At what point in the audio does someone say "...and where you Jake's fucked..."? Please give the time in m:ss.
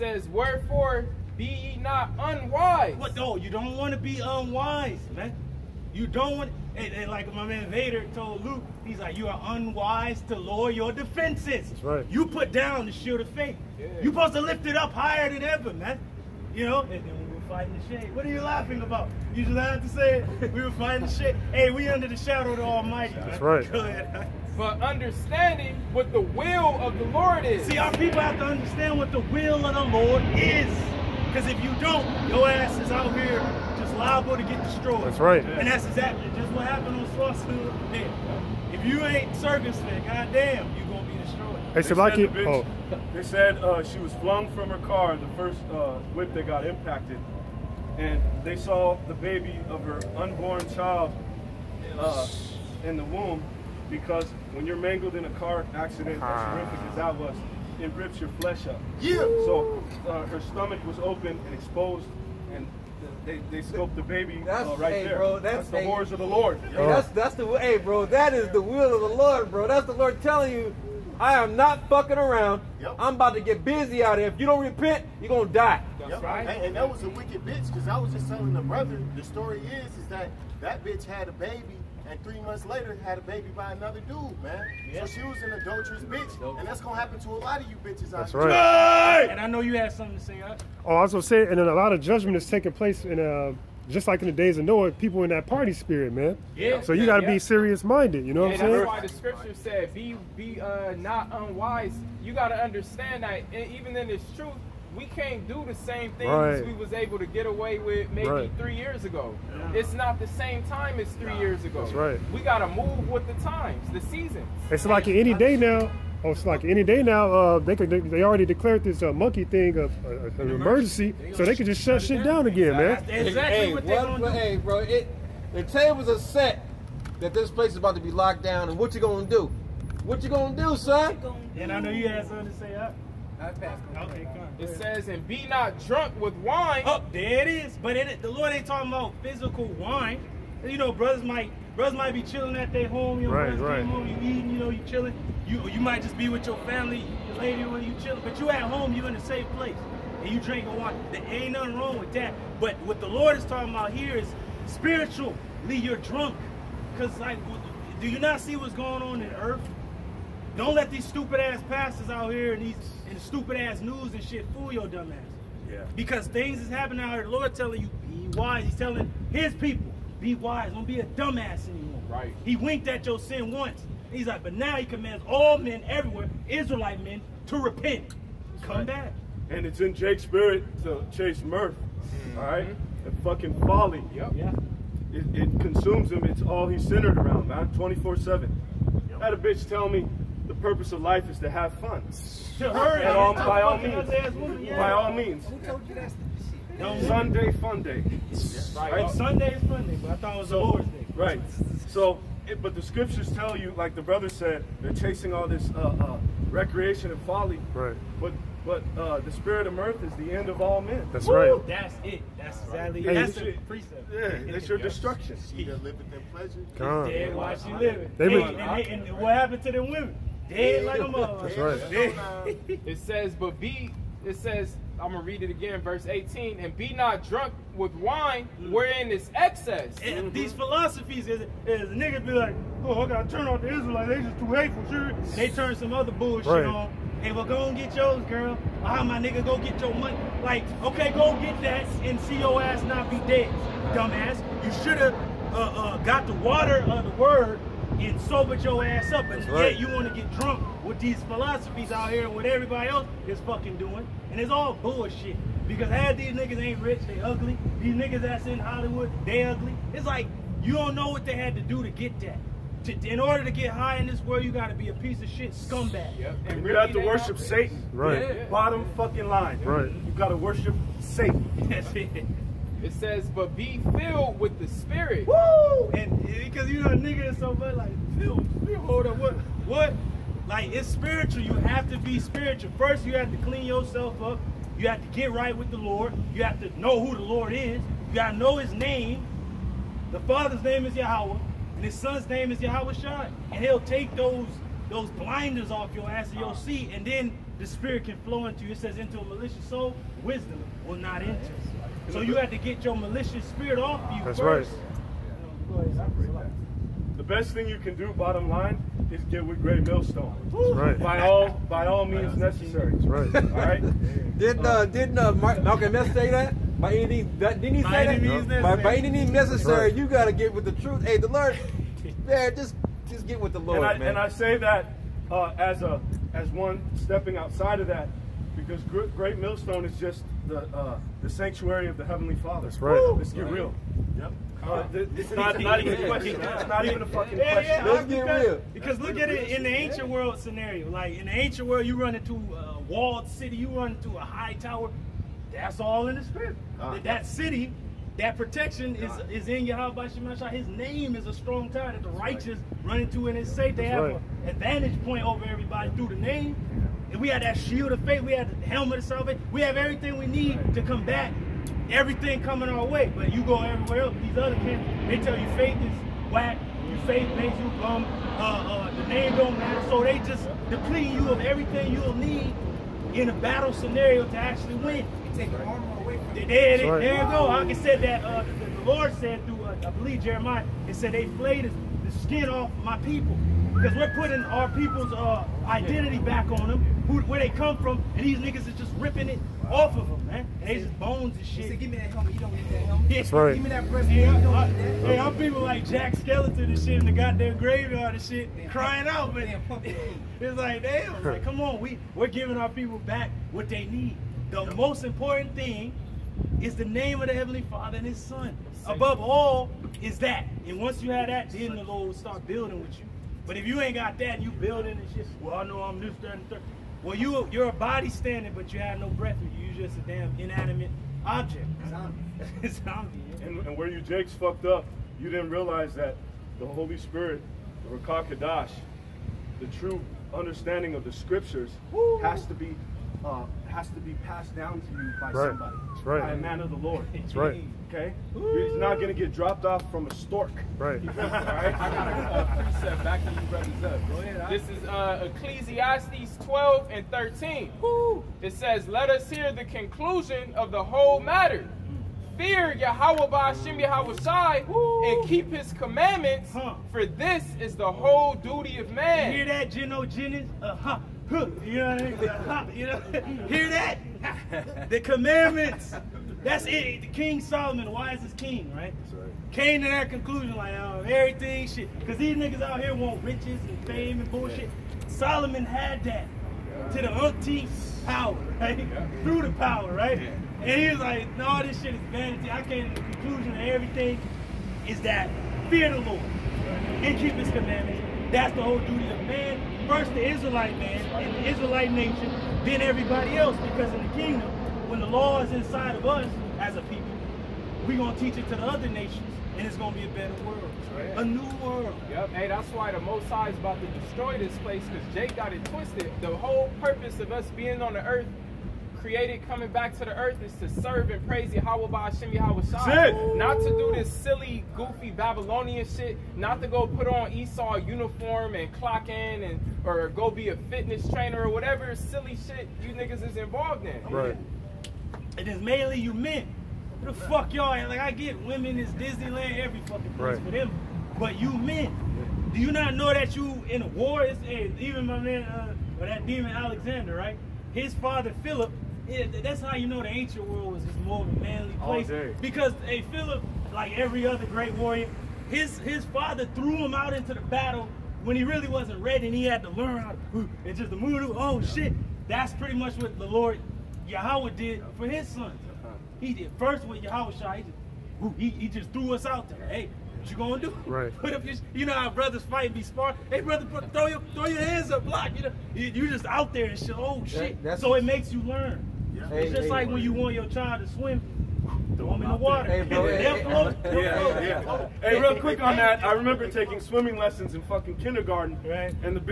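7:03.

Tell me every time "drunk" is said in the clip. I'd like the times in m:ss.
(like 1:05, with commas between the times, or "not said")
2:15, 2:35, 3:47, 4:10.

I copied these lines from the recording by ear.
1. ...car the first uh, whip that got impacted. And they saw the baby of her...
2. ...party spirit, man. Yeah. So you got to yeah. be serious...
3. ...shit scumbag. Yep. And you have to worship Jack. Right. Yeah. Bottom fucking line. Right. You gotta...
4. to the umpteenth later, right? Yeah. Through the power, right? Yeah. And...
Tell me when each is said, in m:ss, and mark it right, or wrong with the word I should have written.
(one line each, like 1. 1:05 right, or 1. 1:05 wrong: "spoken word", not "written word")
1. 0:44 right
2. 1:35 right
3. 4:25 wrong: "Satan", not "Jack"
4. 7:56 wrong: "power", not "later".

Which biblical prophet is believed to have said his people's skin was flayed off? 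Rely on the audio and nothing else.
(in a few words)
Jeremiah.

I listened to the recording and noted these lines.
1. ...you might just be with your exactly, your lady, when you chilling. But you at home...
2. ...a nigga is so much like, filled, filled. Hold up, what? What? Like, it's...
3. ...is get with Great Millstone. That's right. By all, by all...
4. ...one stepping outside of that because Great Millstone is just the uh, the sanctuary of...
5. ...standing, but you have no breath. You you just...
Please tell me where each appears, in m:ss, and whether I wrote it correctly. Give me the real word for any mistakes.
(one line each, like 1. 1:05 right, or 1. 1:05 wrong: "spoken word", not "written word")
1. 2:25 wrong: "family", not "exactly"
2. 4:36 right
3. 5:09 right
4. 5:26 right
5. 6:58 right.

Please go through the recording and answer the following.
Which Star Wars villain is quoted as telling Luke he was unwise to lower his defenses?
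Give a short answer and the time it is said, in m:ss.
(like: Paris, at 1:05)
Vader, at 0:07.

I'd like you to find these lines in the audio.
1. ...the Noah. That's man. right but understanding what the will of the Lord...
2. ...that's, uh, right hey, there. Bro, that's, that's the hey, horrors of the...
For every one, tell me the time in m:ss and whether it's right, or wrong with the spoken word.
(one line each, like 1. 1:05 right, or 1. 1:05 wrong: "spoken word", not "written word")
1. 0:22 wrong: "Almighty", not "Noah"
2. 1:04 right.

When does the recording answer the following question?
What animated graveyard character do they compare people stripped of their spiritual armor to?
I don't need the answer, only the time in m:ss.
6:35.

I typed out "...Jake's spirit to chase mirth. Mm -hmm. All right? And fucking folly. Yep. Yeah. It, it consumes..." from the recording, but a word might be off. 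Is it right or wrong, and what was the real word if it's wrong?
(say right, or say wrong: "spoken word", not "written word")
right.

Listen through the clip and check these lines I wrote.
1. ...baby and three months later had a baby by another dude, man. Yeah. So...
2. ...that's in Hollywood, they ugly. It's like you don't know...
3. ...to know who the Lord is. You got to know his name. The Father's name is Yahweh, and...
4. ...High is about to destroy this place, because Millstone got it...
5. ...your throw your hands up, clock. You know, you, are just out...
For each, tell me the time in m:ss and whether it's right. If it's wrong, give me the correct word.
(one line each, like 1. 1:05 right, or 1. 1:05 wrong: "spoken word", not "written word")
1. 1:21 right
2. 4:18 right
3. 4:46 right
4. 8:23 wrong: "Jake", not "Millstone"
5. 9:24 wrong: "block", not "clock".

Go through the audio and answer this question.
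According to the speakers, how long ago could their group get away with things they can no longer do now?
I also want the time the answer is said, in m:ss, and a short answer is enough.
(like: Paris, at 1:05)
3 years, at 1:48.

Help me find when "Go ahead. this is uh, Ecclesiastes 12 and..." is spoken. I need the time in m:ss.
7:24.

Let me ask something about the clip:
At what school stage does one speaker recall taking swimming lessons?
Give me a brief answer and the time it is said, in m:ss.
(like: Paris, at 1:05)
Kindergarten, at 9:37.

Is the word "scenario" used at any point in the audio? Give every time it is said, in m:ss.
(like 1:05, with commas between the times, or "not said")
5:40, 6:13.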